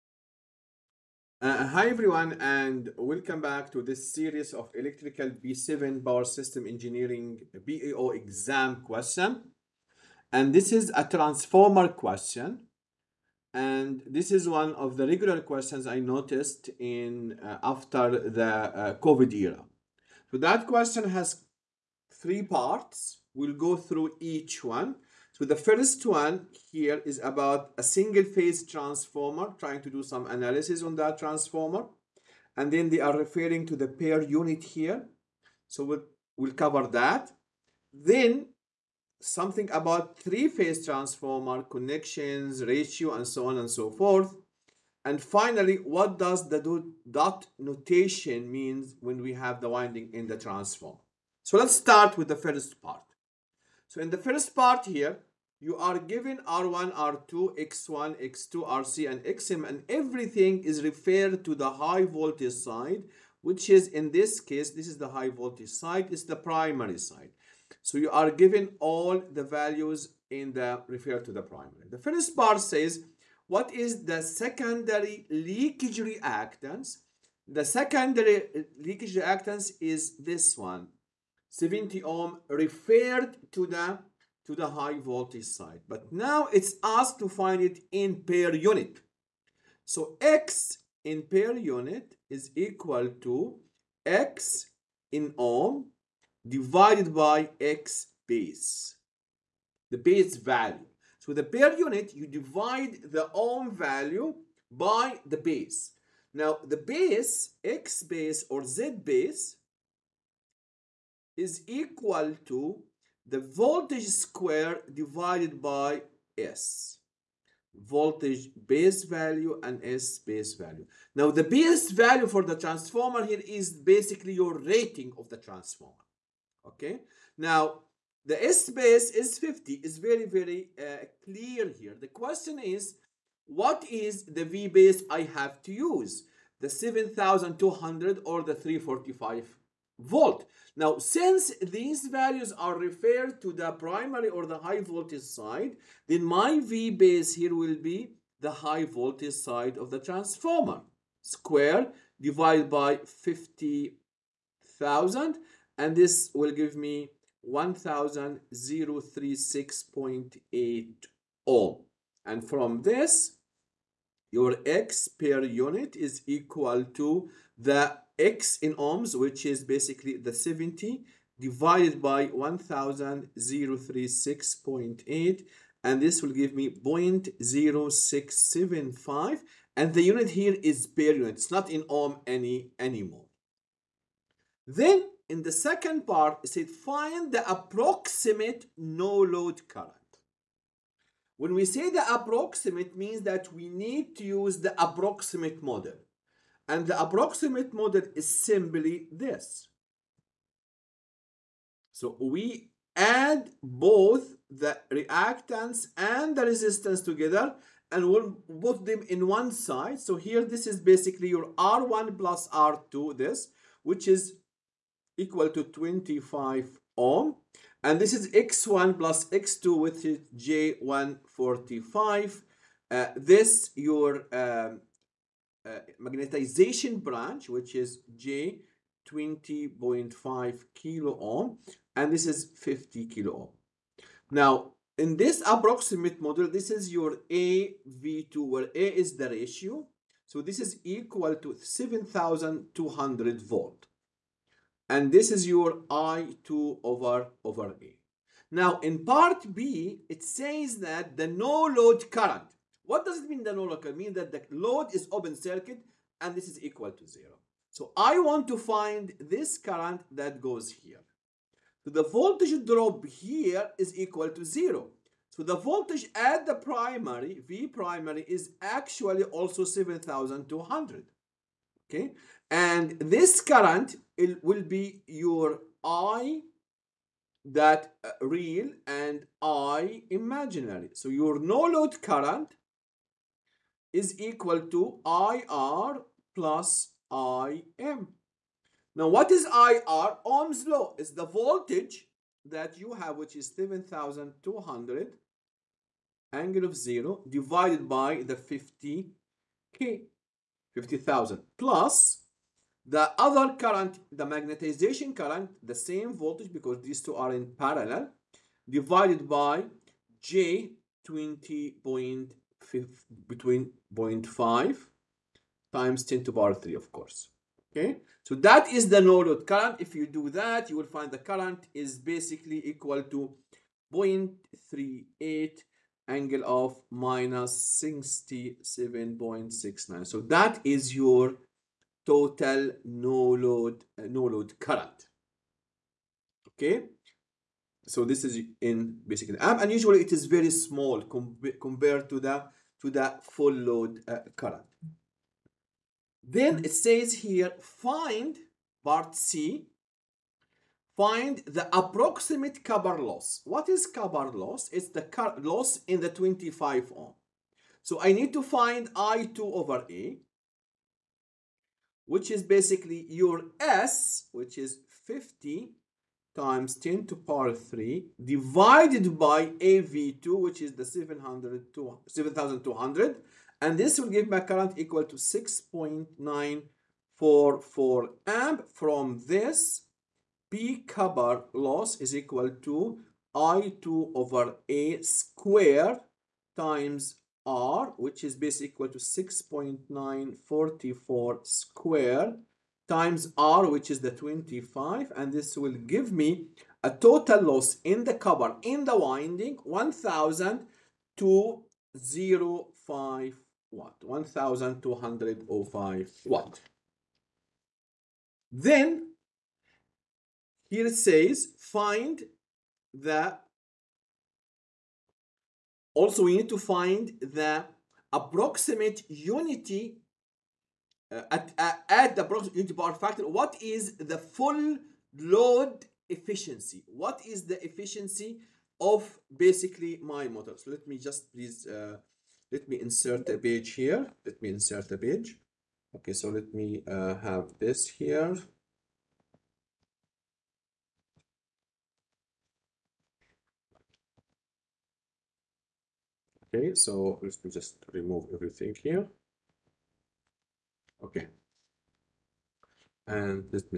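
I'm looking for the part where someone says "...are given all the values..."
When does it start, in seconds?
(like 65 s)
68 s.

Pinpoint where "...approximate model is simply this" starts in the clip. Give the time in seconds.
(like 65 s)
196 s.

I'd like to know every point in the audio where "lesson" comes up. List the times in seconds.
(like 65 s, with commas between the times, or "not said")
not said.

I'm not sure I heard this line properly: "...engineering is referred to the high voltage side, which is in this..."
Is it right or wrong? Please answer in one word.
wrong.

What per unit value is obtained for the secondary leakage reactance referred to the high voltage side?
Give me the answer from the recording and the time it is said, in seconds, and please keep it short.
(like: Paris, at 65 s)
0.0675, at 176 s.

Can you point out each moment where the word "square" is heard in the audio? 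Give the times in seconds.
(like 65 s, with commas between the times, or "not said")
114 s, 151 s, 385 s, 391 s.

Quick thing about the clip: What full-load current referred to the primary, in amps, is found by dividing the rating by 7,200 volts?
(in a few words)
6.944 amp.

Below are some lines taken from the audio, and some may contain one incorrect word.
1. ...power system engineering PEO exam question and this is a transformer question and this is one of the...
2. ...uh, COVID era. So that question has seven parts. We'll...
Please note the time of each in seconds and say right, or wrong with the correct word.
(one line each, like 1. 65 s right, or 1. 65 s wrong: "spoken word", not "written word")
1. 6 s right
2. 18 s wrong: "three", not "seven".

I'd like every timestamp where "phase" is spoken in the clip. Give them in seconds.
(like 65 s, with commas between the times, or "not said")
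28 s, 40 s.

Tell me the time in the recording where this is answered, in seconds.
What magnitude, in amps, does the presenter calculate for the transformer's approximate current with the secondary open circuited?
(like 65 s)
323 s.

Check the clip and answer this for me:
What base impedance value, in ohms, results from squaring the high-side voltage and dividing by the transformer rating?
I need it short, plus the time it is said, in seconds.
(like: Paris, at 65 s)
1036.8 ohm, at 157 s.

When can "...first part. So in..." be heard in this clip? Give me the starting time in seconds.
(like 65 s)
52 s.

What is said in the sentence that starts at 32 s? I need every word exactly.
And then they are referring to the per unit here.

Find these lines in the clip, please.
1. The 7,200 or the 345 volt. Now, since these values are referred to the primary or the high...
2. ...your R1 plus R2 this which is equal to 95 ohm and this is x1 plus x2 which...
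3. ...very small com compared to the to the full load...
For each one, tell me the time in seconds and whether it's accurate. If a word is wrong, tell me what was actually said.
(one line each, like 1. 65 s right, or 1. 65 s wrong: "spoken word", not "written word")
1. 136 s right
2. 211 s wrong: "25", not "95"
3. 340 s right.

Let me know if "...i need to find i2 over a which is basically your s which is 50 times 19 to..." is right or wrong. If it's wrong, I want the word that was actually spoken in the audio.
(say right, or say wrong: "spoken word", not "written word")
wrong: "10", not "19".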